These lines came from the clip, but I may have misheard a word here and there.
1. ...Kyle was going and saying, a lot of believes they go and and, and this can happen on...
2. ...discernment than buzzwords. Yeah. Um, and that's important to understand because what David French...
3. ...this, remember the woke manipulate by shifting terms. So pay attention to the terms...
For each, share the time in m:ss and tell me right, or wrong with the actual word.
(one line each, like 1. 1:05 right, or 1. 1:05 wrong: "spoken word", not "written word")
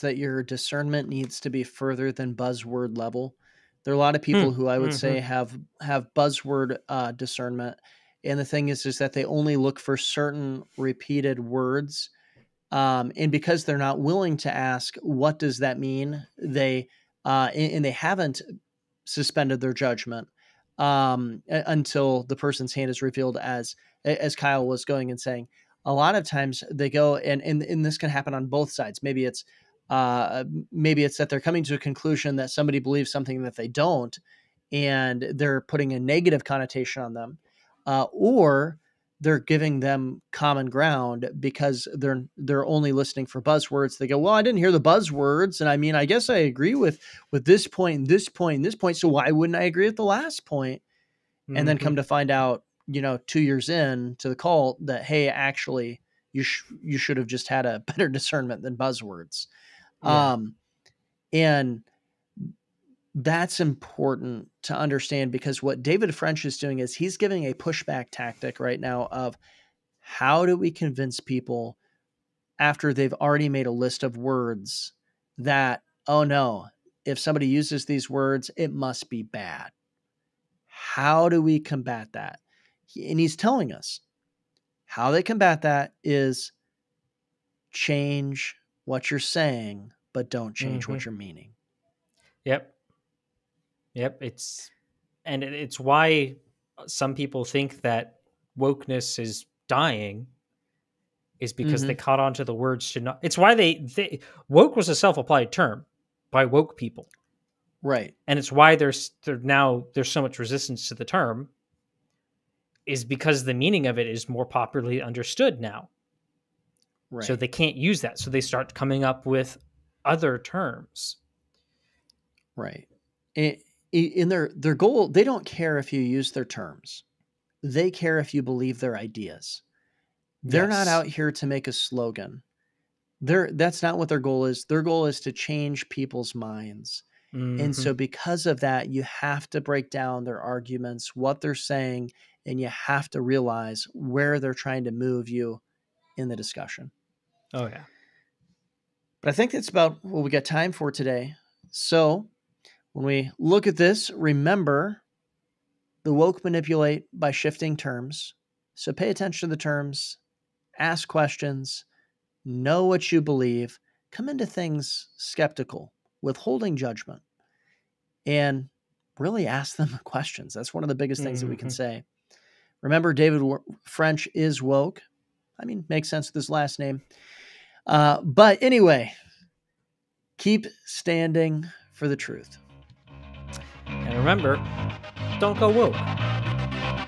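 1. 0:24 wrong: "times", not "believes"
2. 0:58 right
3. 2:33 right.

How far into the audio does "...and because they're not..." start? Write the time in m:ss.
0:13.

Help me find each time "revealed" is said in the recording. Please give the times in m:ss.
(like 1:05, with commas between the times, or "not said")
0:23.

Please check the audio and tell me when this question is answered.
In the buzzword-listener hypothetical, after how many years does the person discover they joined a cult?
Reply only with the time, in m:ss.
0:53.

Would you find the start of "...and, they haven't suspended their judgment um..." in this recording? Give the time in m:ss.
0:17.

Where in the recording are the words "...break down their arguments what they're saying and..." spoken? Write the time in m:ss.
2:19.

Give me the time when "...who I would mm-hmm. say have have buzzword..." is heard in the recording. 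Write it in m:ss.
0:04.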